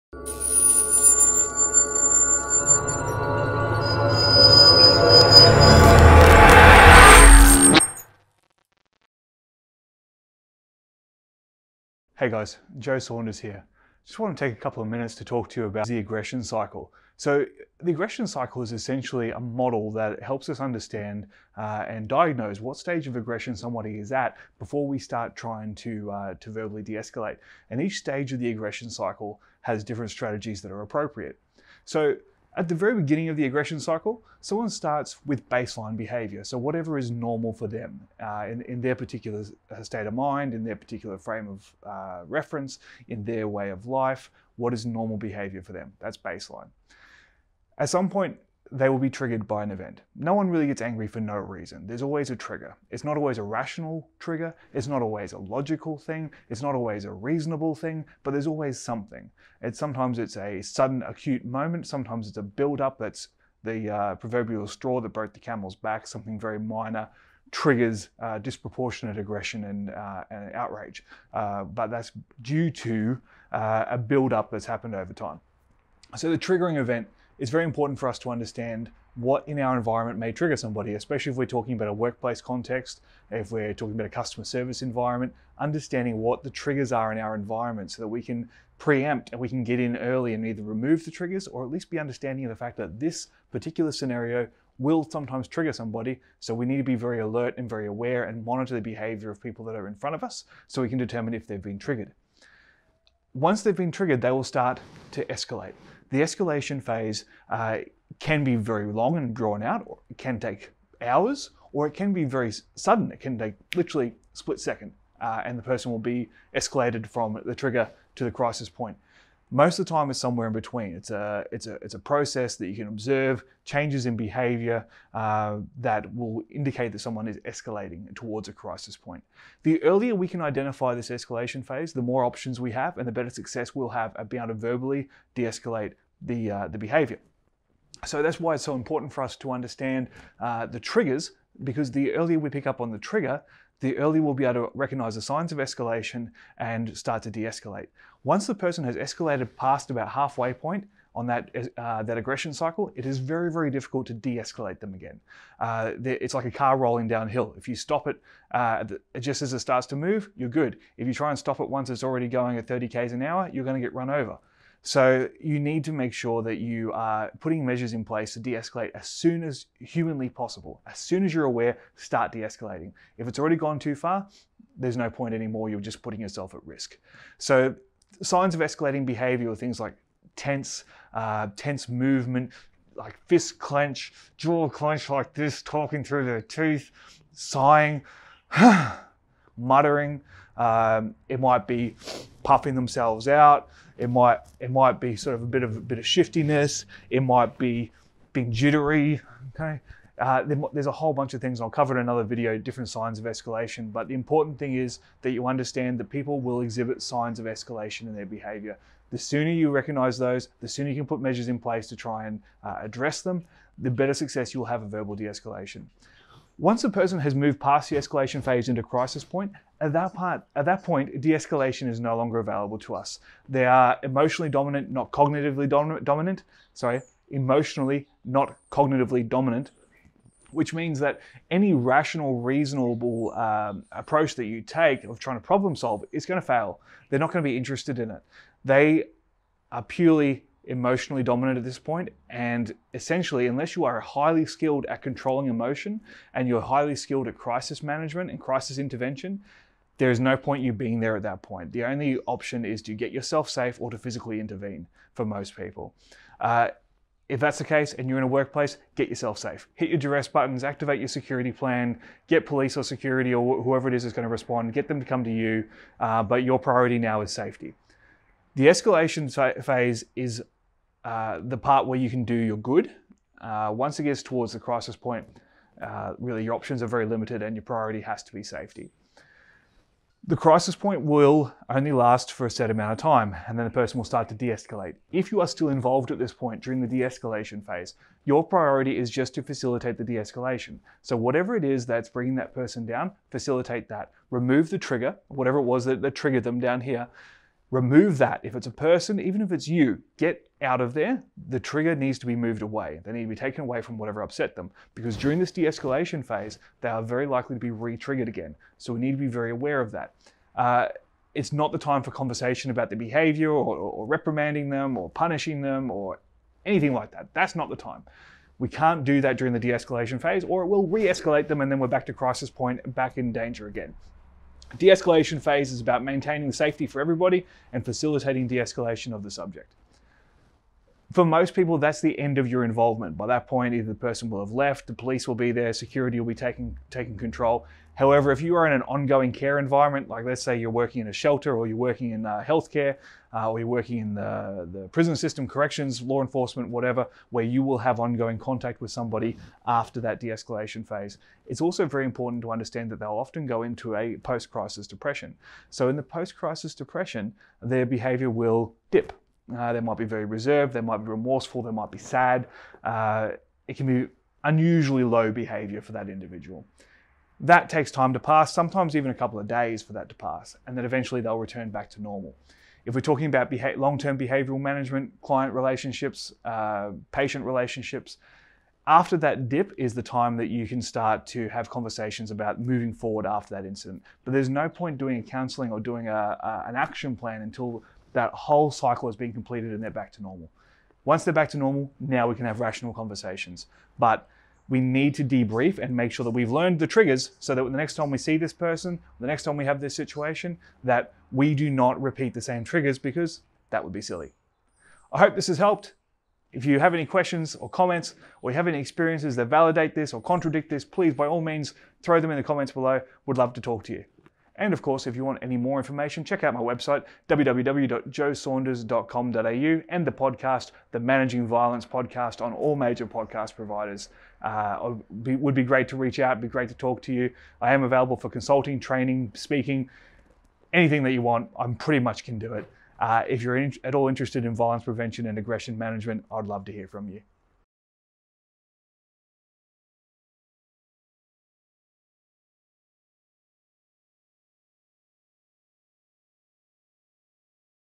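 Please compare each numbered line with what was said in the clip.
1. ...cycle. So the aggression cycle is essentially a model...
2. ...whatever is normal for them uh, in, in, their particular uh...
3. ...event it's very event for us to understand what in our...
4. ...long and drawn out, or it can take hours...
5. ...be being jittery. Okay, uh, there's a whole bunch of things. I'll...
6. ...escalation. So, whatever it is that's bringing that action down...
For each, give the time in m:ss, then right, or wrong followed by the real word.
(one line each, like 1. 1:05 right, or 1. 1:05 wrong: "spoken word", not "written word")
1. 0:16 right
2. 0:36 right
3. 1:16 wrong: "important", not "event"
4. 1:48 right
5. 3:17 right
6. 4:50 wrong: "person", not "action".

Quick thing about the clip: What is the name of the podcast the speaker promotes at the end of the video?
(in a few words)
Managing Violence.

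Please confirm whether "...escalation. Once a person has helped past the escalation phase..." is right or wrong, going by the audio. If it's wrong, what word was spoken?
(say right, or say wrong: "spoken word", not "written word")
wrong: "moved", not "helped".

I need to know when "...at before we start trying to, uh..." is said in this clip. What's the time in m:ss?
0:24.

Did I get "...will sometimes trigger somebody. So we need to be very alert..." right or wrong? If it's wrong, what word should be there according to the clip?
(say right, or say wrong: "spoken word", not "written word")
right.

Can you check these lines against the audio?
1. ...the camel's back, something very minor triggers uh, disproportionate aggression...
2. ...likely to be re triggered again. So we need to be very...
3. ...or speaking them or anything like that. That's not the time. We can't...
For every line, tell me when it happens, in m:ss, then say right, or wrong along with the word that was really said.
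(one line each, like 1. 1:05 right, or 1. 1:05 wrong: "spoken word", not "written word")
1. 1:05 right
2. 5:07 right
3. 5:14 wrong: "punishing", not "speaking".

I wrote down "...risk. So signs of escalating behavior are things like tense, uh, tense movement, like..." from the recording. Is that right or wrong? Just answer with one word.
right.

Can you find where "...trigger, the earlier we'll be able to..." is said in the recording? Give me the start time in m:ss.
2:22.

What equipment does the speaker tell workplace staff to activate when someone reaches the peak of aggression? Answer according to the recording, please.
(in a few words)
Duress buttons.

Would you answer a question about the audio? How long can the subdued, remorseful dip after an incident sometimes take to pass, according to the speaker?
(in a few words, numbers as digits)
A couple of days.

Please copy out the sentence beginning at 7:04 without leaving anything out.
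Uh, would be great to reach out, it'd be great to talk to you.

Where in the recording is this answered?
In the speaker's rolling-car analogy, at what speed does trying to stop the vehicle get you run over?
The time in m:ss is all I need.
2:42.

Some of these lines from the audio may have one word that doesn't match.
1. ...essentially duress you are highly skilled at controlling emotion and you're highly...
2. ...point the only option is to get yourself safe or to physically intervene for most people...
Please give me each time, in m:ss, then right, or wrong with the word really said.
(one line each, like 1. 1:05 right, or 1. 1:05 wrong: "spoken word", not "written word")
1. 4:02 wrong: "unless", not "duress"
2. 4:11 right.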